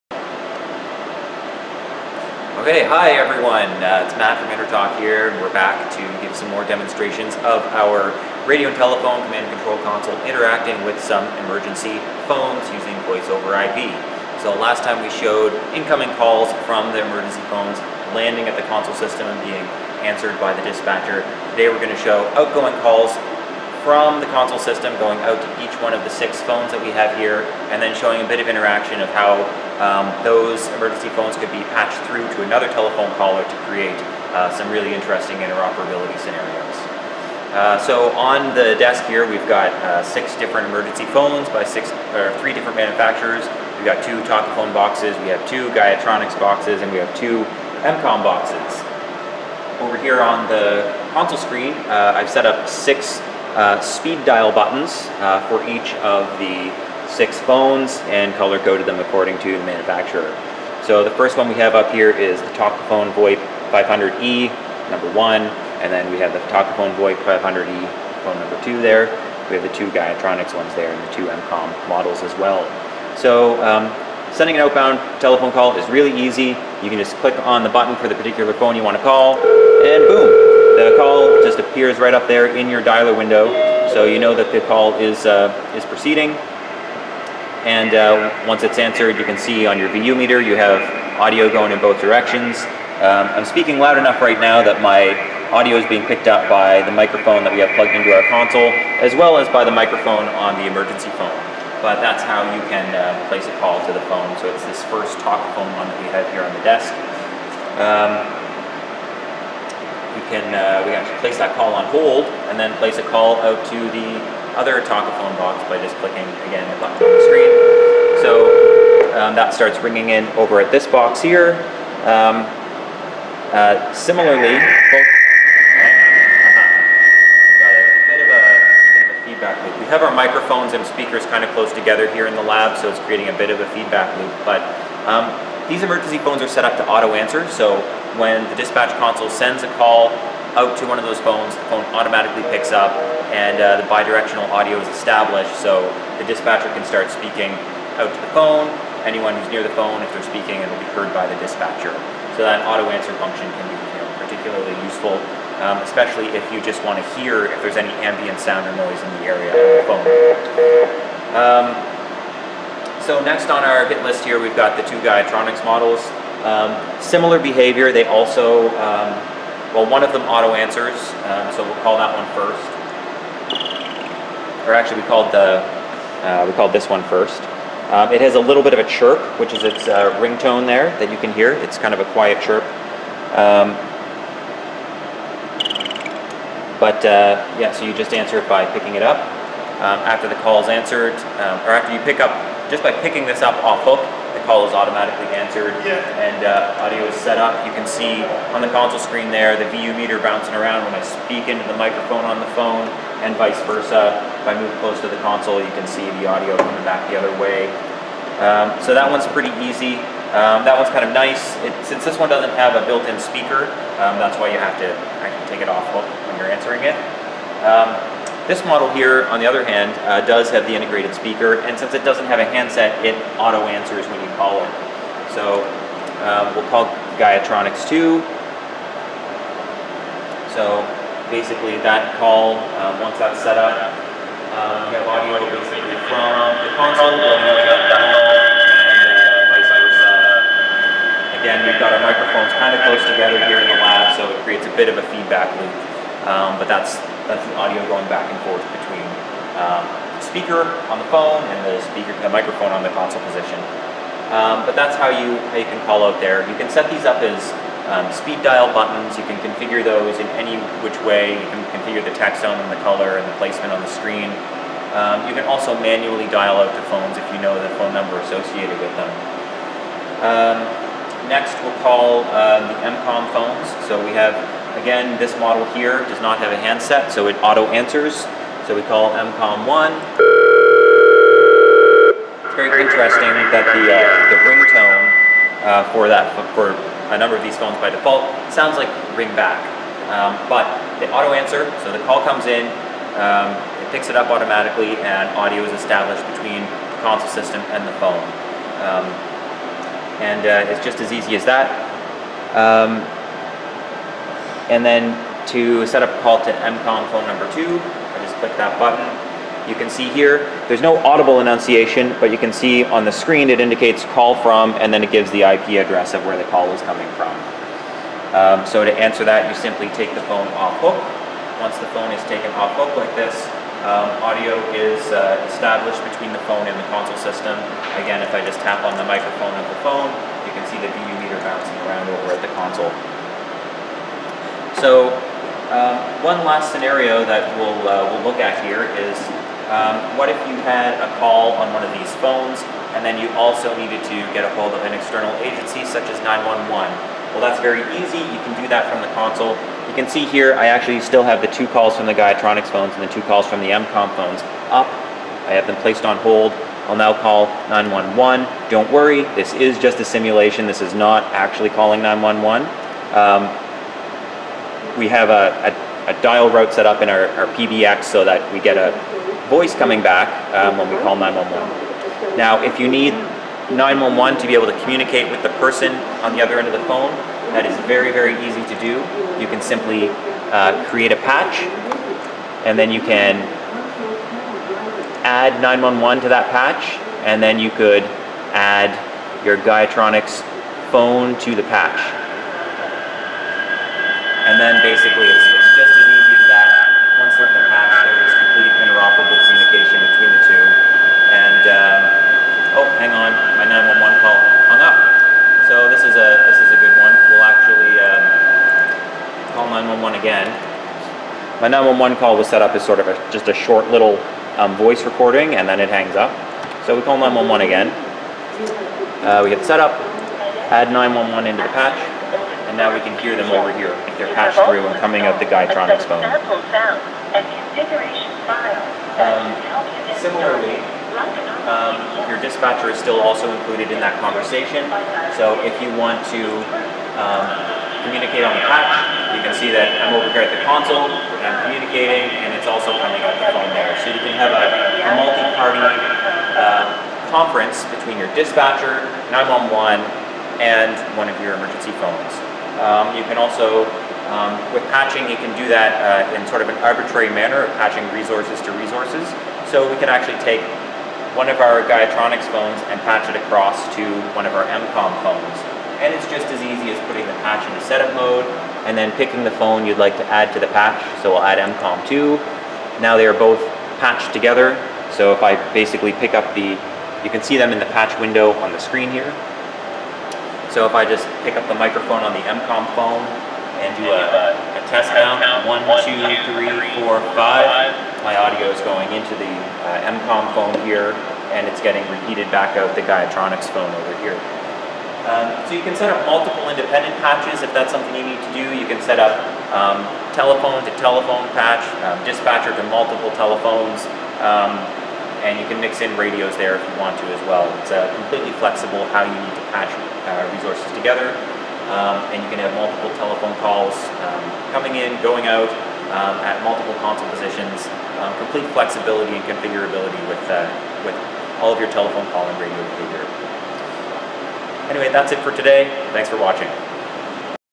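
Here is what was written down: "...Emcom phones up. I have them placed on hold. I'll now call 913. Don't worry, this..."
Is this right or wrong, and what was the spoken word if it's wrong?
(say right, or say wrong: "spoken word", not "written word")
wrong: "911", not "913".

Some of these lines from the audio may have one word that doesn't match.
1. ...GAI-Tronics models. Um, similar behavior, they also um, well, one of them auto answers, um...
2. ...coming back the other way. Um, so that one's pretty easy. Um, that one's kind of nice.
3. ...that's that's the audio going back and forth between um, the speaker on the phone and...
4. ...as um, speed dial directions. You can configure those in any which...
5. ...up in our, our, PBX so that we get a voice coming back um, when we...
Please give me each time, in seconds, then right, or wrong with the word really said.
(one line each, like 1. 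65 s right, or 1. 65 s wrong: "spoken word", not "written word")
1. 165 s right
2. 206 s right
3. 246 s right
4. 257 s wrong: "buttons", not "directions"
5. 366 s right.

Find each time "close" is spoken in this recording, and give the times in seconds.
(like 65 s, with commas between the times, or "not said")
131 s, 204 s, 242 s.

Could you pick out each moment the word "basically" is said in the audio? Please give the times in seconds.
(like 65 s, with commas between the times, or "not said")
231 s, 235 s, 394 s, 475 s.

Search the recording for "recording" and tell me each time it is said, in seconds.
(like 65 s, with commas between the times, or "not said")
415 s.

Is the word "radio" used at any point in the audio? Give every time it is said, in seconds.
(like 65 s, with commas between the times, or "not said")
8 s, 506 s, 522 s.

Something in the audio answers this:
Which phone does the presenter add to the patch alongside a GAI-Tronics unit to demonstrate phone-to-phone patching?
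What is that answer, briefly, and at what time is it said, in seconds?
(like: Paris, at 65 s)
Emcom 2, at 471 s.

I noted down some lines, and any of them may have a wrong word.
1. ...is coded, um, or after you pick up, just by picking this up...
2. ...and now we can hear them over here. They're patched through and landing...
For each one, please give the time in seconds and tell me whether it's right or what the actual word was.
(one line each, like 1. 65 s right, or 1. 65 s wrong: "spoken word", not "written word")
1. 190 s wrong: "answered", not "coded"
2. 422 s wrong: "coming", not "landing".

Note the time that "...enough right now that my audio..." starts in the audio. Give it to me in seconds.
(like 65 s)
93 s.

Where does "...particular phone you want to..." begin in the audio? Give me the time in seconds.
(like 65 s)
78 s.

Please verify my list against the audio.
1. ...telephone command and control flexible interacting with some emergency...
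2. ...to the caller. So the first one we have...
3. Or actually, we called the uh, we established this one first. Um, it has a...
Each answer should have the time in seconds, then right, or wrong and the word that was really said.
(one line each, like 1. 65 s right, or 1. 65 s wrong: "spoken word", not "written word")
1. 8 s wrong: "console", not "flexible"
2. 59 s wrong: "manufacturer", not "caller"
3. 174 s wrong: "called", not "established".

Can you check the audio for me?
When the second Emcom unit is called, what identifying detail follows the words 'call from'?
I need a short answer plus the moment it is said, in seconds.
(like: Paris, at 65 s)
The IP address, at 315 s.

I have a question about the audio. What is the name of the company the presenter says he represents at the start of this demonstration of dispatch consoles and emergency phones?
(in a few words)
InterTalk.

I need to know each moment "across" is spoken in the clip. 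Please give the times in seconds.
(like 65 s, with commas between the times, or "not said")
463 s.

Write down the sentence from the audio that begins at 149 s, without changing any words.
Anyone who's near the phone, if they're speaking, it'll be heard by the dispatcher.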